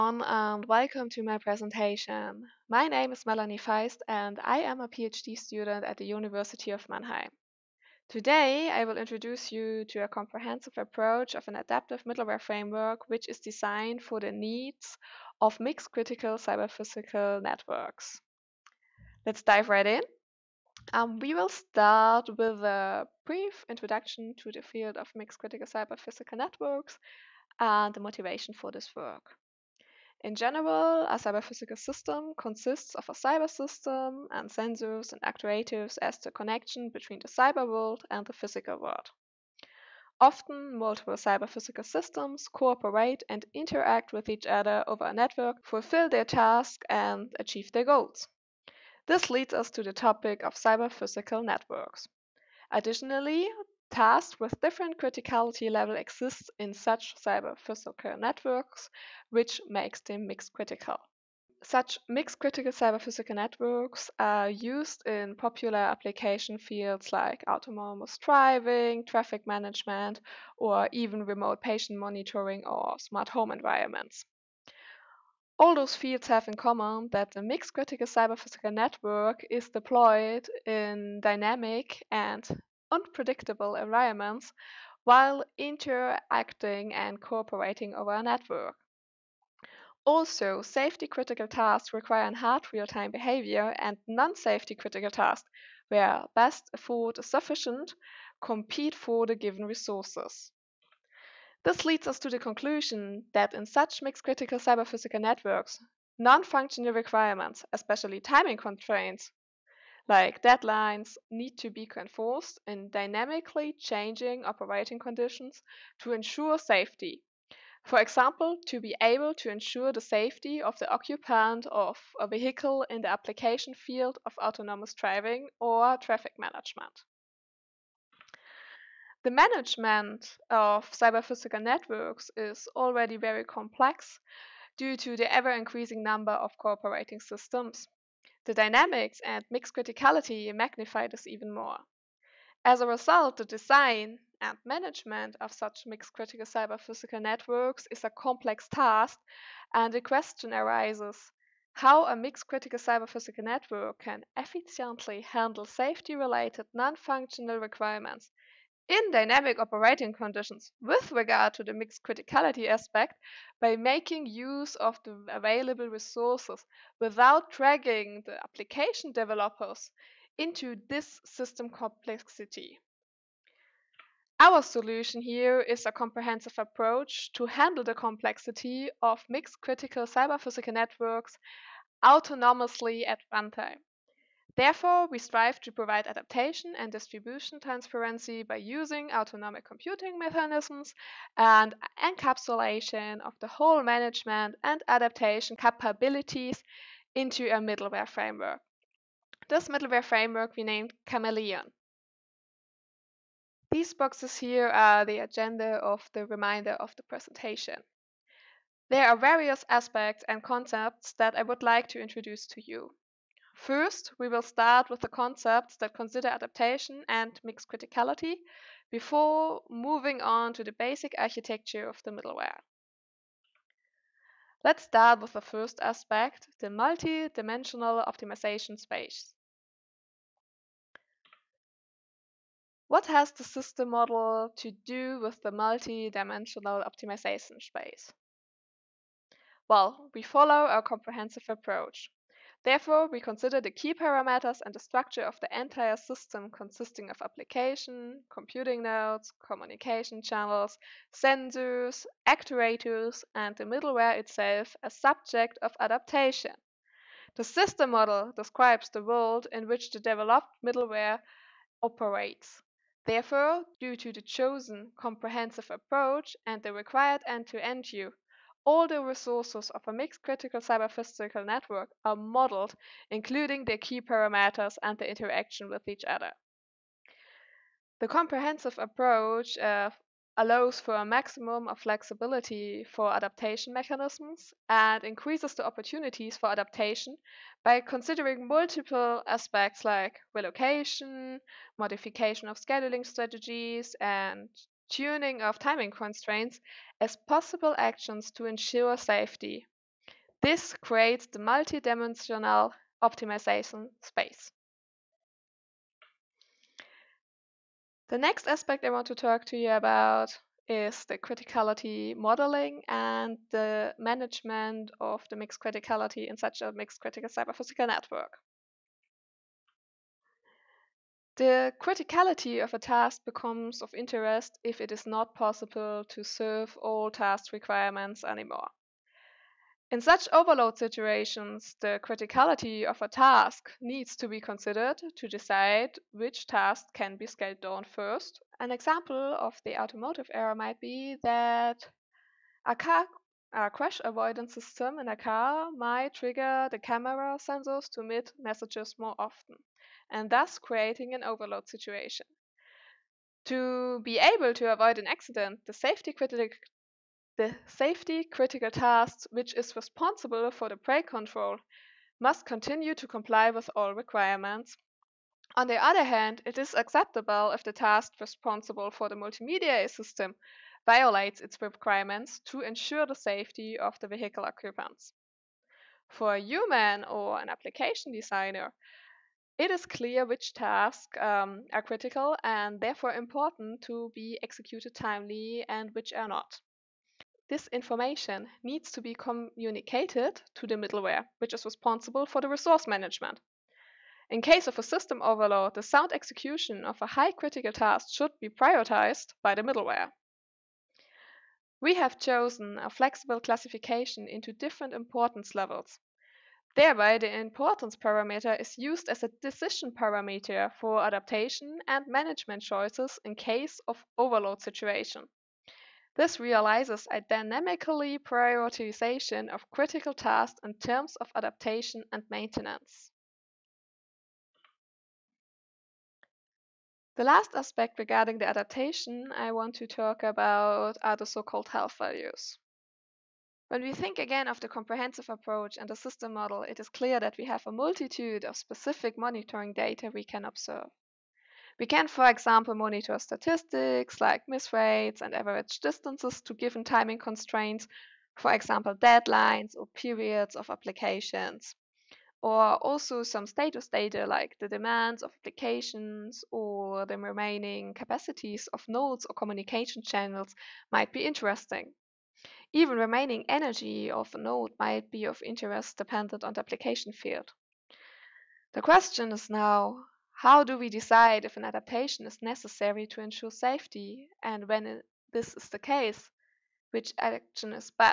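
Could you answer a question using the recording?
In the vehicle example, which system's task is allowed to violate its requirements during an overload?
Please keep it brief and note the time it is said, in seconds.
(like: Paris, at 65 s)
multimedia system, at 369 s.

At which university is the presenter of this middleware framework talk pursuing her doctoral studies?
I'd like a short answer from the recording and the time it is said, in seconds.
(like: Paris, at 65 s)
University of Mannheim, at 6 s.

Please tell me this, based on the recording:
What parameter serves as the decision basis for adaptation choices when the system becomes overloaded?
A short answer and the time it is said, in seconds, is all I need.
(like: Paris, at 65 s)
importance parameter, at 407 s.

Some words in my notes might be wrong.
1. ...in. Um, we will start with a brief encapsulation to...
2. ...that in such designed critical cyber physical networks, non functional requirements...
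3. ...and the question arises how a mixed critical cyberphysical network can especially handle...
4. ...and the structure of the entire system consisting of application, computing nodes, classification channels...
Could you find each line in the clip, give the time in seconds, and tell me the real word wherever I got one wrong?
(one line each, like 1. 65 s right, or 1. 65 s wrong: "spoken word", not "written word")
1. 19 s wrong: "introduction", not "encapsulation"
2. 103 s wrong: "mixed", not "designed"
3. 149 s wrong: "efficiently", not "especially"
4. 244 s wrong: "communication", not "classification".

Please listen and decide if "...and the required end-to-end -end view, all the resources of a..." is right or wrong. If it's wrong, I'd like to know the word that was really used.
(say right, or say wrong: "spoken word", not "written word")
right.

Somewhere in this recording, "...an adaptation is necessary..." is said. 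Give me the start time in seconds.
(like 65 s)
471 s.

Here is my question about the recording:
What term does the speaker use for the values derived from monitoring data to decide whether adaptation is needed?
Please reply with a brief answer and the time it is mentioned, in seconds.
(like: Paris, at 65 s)
health values, at 431 s.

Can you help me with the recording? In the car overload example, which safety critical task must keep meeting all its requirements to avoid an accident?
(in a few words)
brake control.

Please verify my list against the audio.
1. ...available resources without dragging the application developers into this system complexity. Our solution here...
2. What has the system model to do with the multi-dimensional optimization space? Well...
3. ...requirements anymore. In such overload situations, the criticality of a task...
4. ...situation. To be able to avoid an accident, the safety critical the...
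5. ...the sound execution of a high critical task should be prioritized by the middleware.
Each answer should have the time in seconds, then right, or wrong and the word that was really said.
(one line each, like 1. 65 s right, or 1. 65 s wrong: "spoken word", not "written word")
1. 165 s right
2. 232 s right
3. 327 s right
4. 351 s right
5. 395 s right.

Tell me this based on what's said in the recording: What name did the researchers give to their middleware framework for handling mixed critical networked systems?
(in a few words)
Chameleon.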